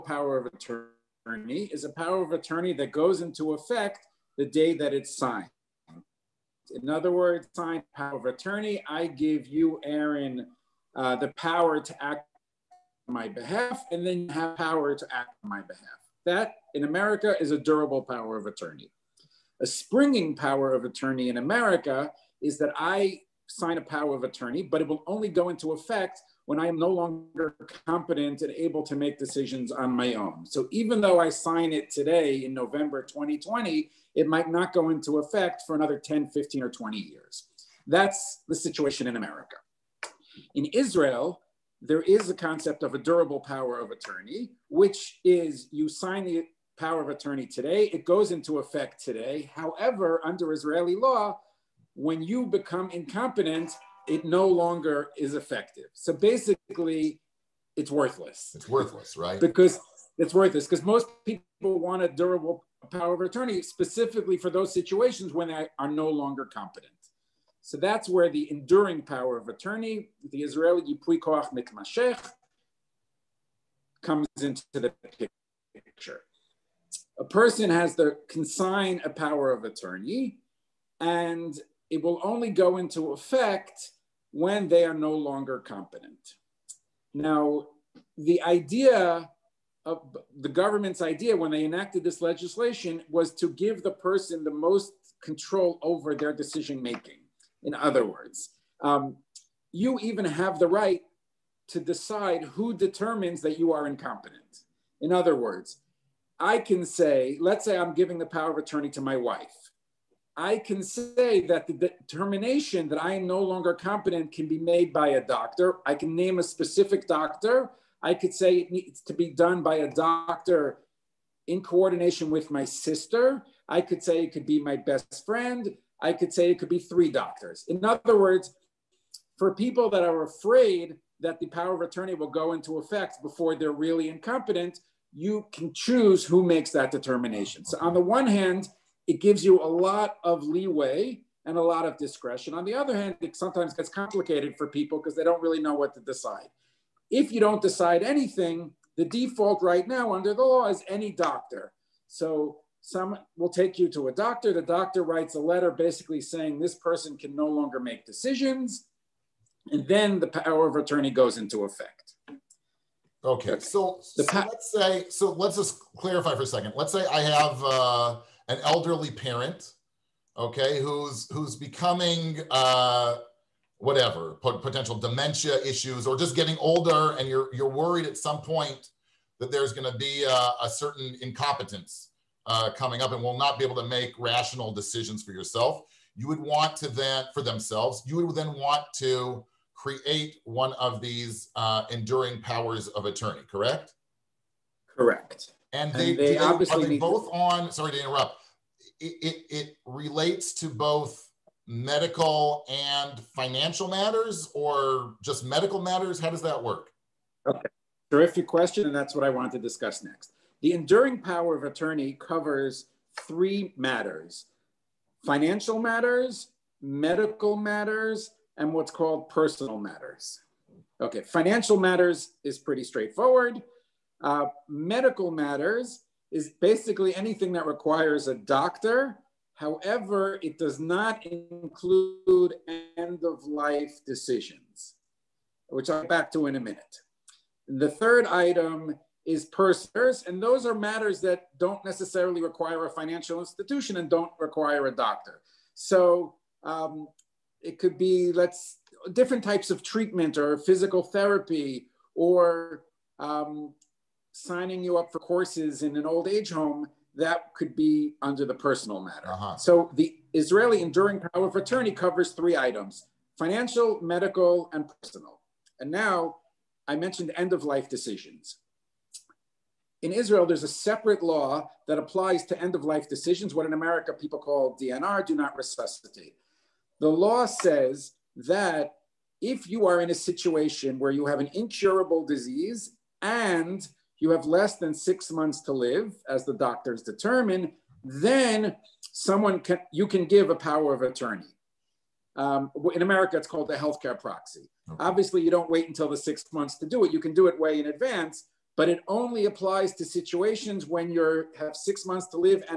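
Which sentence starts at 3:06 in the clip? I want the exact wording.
You would want to then, for themselves, you would then want to create one of these uh, enduring powers of attorney, correct?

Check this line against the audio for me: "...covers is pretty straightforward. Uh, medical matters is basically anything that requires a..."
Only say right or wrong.
wrong.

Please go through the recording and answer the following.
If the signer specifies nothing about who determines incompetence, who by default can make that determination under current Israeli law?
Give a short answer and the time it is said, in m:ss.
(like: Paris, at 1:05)
Any doctor, at 2:30.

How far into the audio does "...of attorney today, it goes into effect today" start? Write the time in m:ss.
0:47.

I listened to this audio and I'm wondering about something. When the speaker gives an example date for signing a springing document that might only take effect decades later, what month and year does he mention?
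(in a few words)
November 2020.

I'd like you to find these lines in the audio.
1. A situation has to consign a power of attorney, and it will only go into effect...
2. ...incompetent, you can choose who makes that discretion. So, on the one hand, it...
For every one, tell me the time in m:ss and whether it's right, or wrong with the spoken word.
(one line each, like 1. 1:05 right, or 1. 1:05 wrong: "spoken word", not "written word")
1. 1:17 wrong: "person", not "situation"
2. 2:14 wrong: "determination", not "discretion".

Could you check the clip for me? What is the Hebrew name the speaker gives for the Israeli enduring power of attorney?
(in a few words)
Yipui Koach Mitmashech.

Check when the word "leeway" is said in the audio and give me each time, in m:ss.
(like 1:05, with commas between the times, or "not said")
2:20.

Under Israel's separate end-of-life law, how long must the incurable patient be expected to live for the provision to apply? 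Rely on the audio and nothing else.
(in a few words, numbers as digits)
Less than six months.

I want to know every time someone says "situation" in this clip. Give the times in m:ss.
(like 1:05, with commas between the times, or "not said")
0:38, 1:04, 4:40, 5:00.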